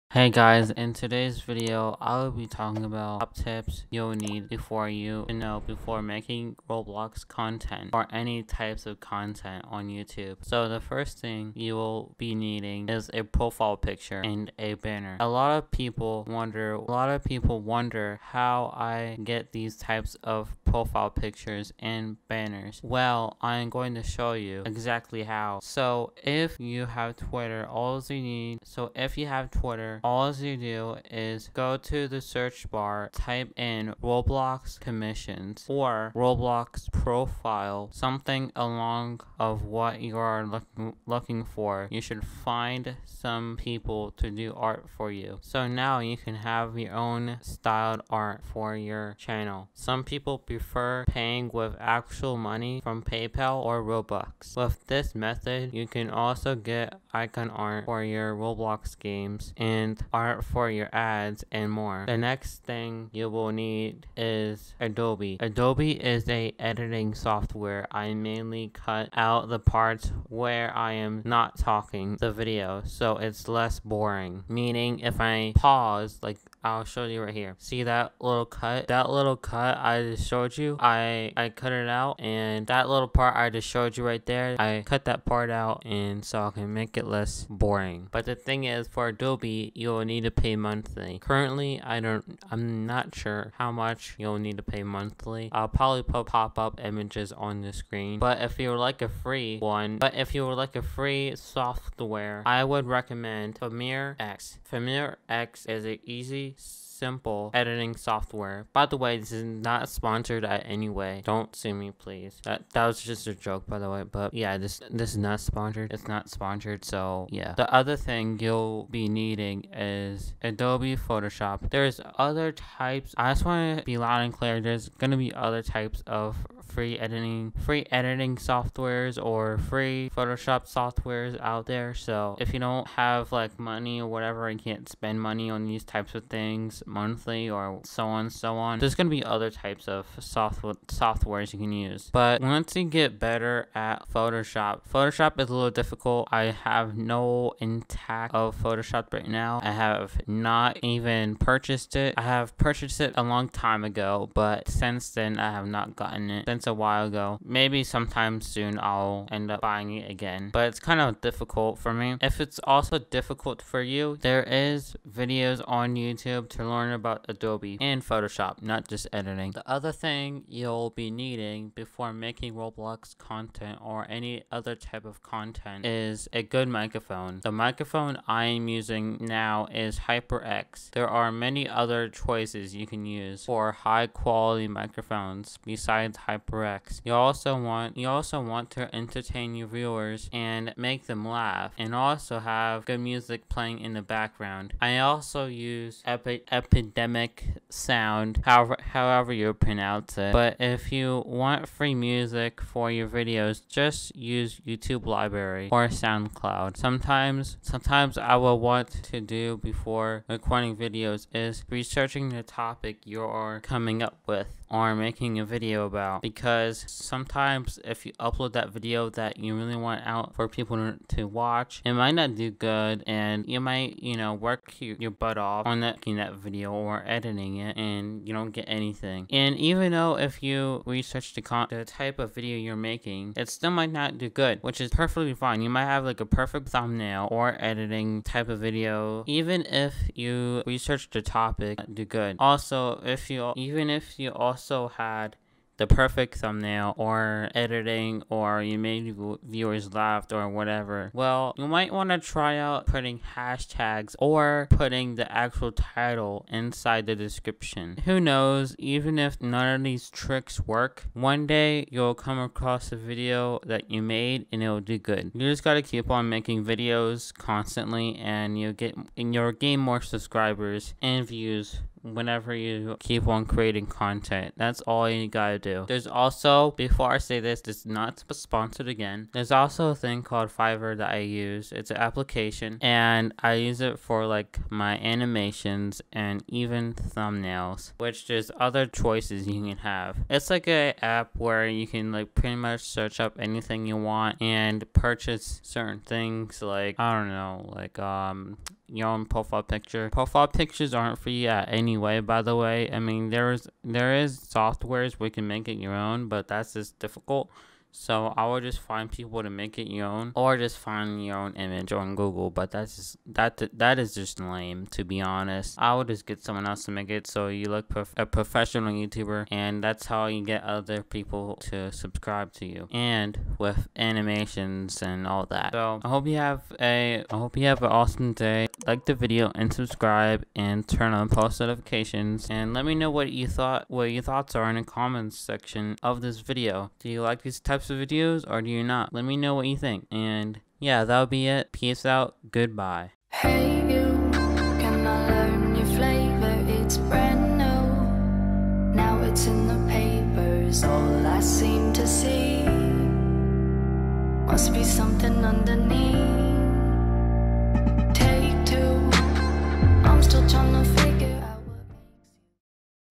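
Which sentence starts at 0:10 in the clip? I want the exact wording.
So the first thing you will be needing is a profile picture and a banner.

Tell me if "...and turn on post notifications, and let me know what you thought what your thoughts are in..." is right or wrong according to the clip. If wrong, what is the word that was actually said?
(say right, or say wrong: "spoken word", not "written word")
right.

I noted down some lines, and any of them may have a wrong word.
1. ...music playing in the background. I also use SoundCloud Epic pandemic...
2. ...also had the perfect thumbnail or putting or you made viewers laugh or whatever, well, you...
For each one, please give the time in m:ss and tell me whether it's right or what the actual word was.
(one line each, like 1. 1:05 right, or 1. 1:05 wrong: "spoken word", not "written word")
1. 3:12 wrong: "Epic", not "SoundCloud"
2. 4:04 wrong: "editing", not "putting".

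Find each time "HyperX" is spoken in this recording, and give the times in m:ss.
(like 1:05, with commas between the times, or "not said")
2:59, 3:06.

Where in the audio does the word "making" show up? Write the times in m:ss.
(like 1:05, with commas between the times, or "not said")
0:06, 2:52, 3:34, 3:52, 4:26.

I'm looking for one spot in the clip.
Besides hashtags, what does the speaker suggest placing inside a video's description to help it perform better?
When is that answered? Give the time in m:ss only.
4:15.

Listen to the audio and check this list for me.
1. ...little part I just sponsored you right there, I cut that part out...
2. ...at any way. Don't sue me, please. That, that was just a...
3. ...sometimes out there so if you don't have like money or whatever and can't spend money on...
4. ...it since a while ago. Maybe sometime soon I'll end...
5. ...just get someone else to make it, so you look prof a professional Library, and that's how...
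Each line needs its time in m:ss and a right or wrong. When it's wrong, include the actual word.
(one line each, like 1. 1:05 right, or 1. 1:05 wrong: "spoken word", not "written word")
1. 1:22 wrong: "showed", not "sponsored"
2. 1:50 right
3. 2:10 wrong: "softwares", not "sometimes"
4. 2:36 right
5. 5:16 wrong: "YouTuber", not "Library".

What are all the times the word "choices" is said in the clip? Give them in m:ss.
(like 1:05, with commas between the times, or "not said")
3:02, 4:48.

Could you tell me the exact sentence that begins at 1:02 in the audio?
The next thing you will need is Adobe.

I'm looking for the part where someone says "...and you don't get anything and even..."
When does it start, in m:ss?
3:47.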